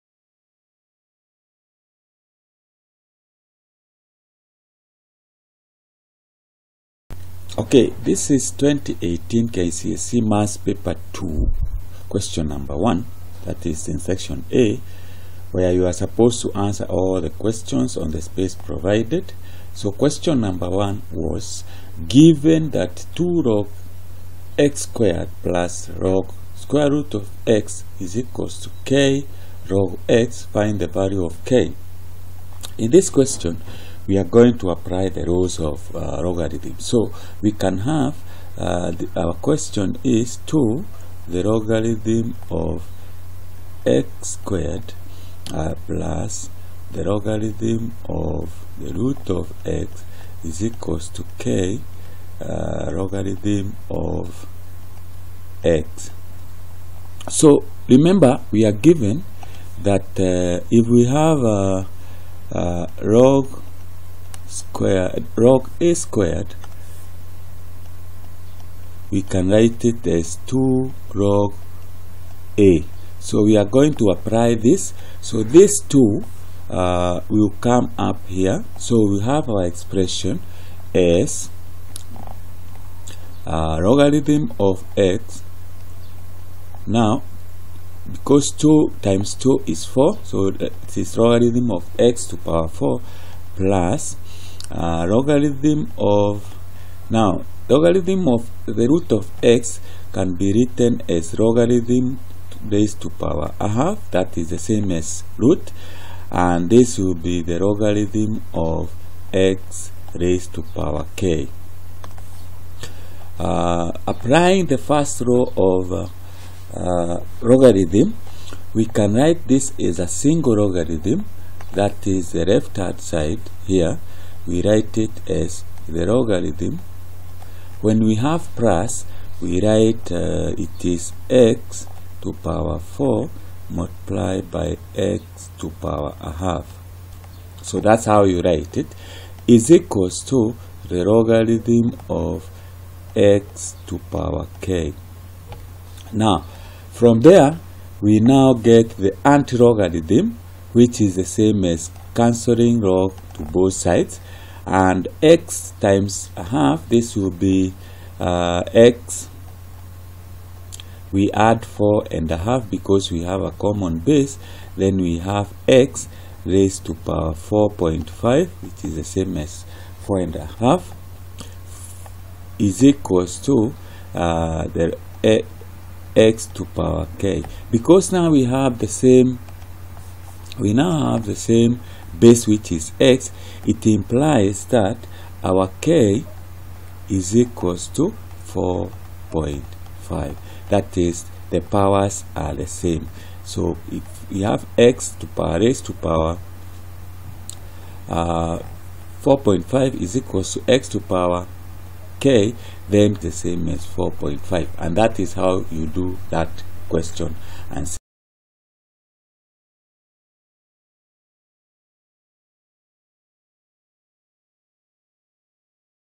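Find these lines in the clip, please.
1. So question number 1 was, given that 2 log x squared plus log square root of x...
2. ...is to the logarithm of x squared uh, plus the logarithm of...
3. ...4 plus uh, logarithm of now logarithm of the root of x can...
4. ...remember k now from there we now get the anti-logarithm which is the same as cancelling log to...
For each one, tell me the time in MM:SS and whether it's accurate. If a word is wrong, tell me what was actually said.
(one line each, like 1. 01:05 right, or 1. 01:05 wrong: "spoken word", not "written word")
1. 00:19 right
2. 00:40 right
3. 01:32 right
4. 02:24 wrong: "power", not "remember".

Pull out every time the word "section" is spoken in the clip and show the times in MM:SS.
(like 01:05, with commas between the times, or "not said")
00:13.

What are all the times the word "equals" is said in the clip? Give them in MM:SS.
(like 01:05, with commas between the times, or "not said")
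00:28, 00:50, 02:19, 02:52, 03:07, 03:20.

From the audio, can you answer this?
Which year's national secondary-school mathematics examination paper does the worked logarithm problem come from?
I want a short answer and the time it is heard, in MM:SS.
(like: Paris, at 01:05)
2018, at 00:08.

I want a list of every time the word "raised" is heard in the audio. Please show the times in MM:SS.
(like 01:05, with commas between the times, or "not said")
01:42, 01:50, 02:46, 03:15.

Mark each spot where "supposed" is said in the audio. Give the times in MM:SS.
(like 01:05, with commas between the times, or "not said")
00:15.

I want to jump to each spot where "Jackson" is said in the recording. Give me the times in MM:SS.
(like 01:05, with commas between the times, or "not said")
not said.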